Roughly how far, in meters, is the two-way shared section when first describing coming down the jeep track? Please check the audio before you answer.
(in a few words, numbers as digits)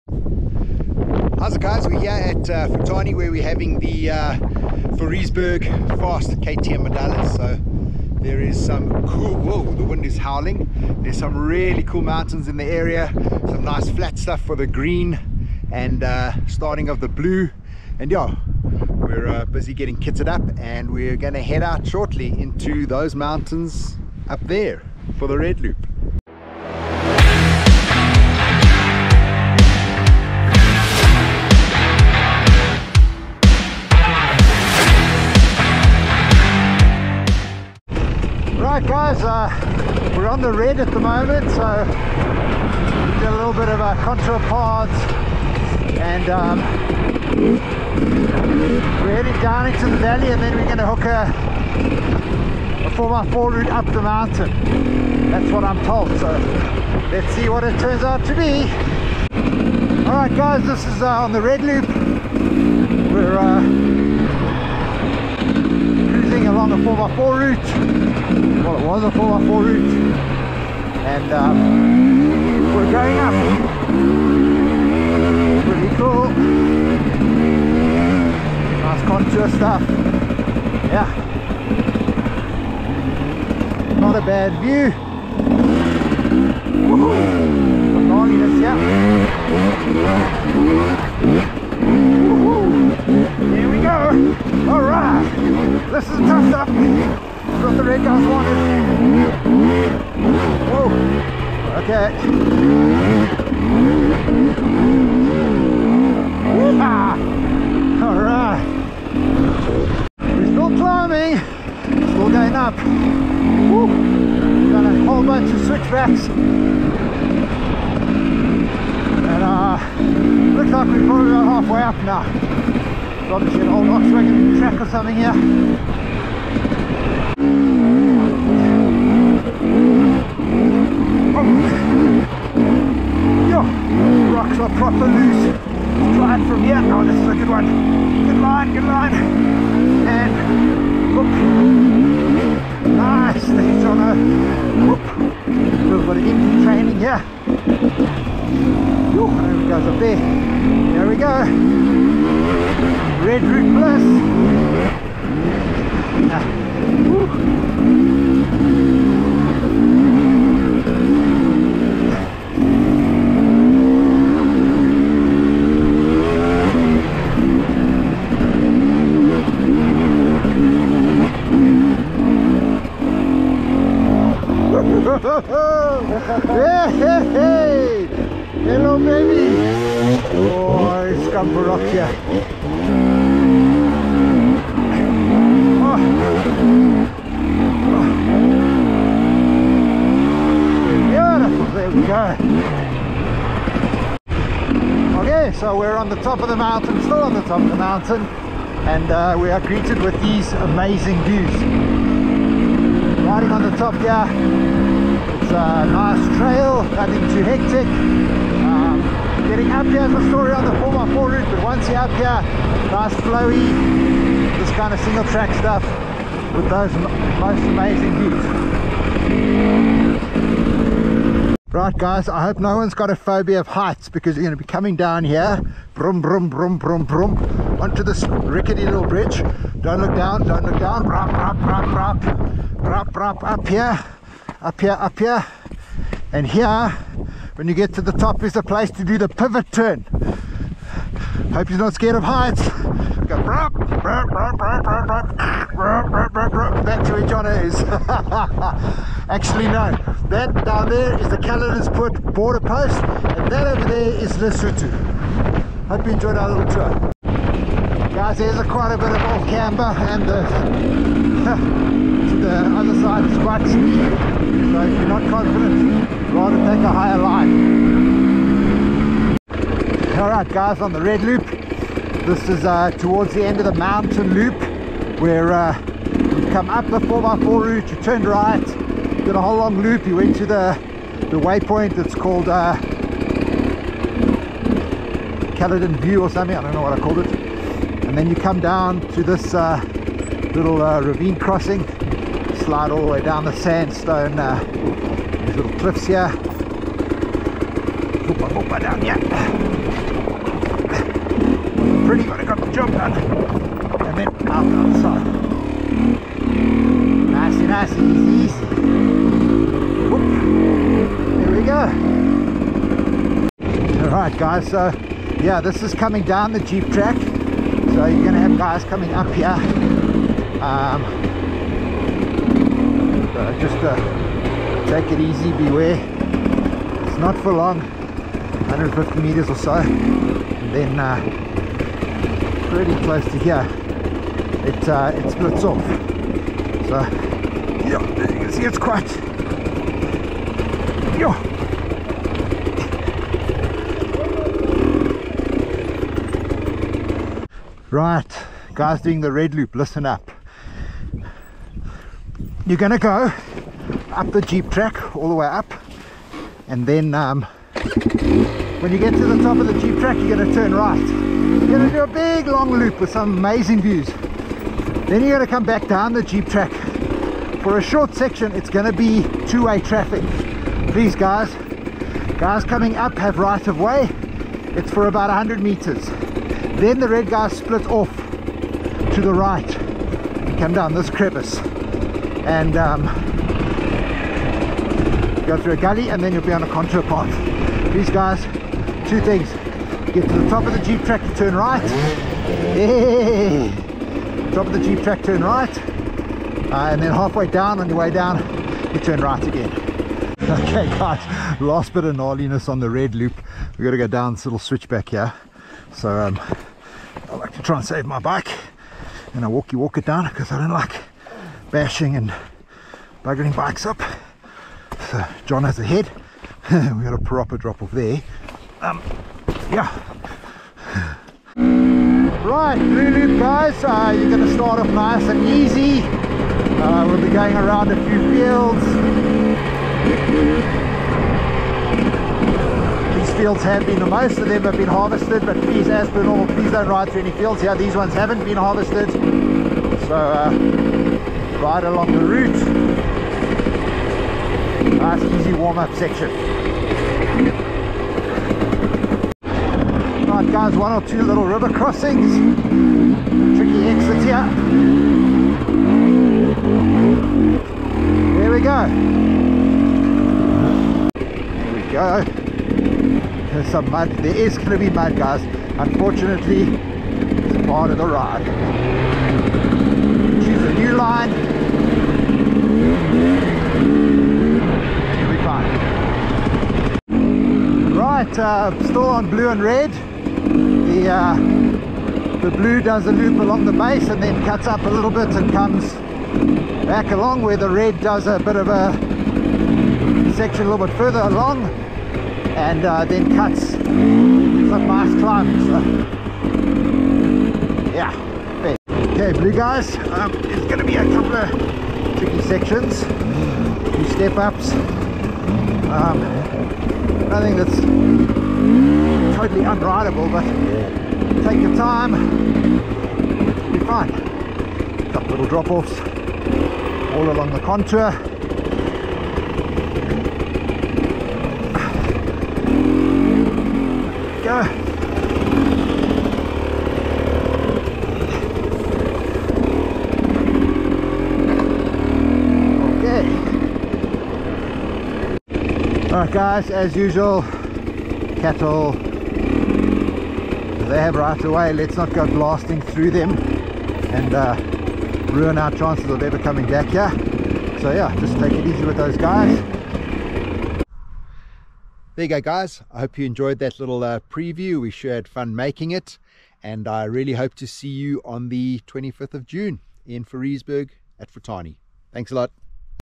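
150 meters.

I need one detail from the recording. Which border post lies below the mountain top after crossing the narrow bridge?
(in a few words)
Caledonspoort.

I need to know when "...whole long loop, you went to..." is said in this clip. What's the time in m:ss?
4:39.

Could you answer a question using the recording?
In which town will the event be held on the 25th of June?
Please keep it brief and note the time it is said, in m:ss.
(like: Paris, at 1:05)
Fouriesburg, at 9:20.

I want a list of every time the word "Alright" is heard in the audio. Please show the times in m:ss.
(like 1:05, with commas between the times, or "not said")
1:00, 4:30.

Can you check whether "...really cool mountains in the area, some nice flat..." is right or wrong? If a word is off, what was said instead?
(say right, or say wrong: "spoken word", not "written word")
right.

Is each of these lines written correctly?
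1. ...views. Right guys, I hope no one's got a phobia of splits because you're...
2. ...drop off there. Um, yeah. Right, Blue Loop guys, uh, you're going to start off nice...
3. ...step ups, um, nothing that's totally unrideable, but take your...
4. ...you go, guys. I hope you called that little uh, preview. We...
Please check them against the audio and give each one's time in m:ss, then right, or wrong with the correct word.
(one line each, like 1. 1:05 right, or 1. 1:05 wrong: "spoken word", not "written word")
1. 3:41 wrong: "heights", not "splits"
2. 6:57 right
3. 8:24 right
4. 9:12 wrong: "enjoyed", not "called".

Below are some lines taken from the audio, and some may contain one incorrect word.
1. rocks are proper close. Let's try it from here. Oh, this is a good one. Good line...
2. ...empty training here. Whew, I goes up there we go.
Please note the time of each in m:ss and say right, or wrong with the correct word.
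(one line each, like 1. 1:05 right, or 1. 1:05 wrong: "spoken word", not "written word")
1. 2:14 wrong: "loose", not "close"
2. 2:26 right.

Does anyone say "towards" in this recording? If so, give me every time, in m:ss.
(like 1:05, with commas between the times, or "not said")
4:32.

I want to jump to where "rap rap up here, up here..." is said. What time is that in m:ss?
3:52.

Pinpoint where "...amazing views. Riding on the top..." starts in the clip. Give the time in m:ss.
3:20.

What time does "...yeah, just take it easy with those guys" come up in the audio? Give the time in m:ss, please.
9:07.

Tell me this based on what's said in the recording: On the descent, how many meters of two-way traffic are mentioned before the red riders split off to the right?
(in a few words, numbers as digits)
100 meters.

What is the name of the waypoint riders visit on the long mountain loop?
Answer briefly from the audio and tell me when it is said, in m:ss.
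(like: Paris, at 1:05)
Caledon View, at 4:45.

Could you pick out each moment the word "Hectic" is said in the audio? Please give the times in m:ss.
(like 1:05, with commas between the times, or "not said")
3:27.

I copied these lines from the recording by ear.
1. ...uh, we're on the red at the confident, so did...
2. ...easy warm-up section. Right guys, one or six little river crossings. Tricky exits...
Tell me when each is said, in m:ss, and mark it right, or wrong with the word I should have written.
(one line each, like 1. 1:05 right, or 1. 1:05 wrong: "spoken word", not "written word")
1. 0:39 wrong: "moment", not "confident"
2. 7:25 wrong: "two", not "six".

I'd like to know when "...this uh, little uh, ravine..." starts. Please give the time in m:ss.
4:49.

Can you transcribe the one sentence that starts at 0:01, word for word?
We're here at uh, Futani where we're having the uh, Fast KTM Madalas.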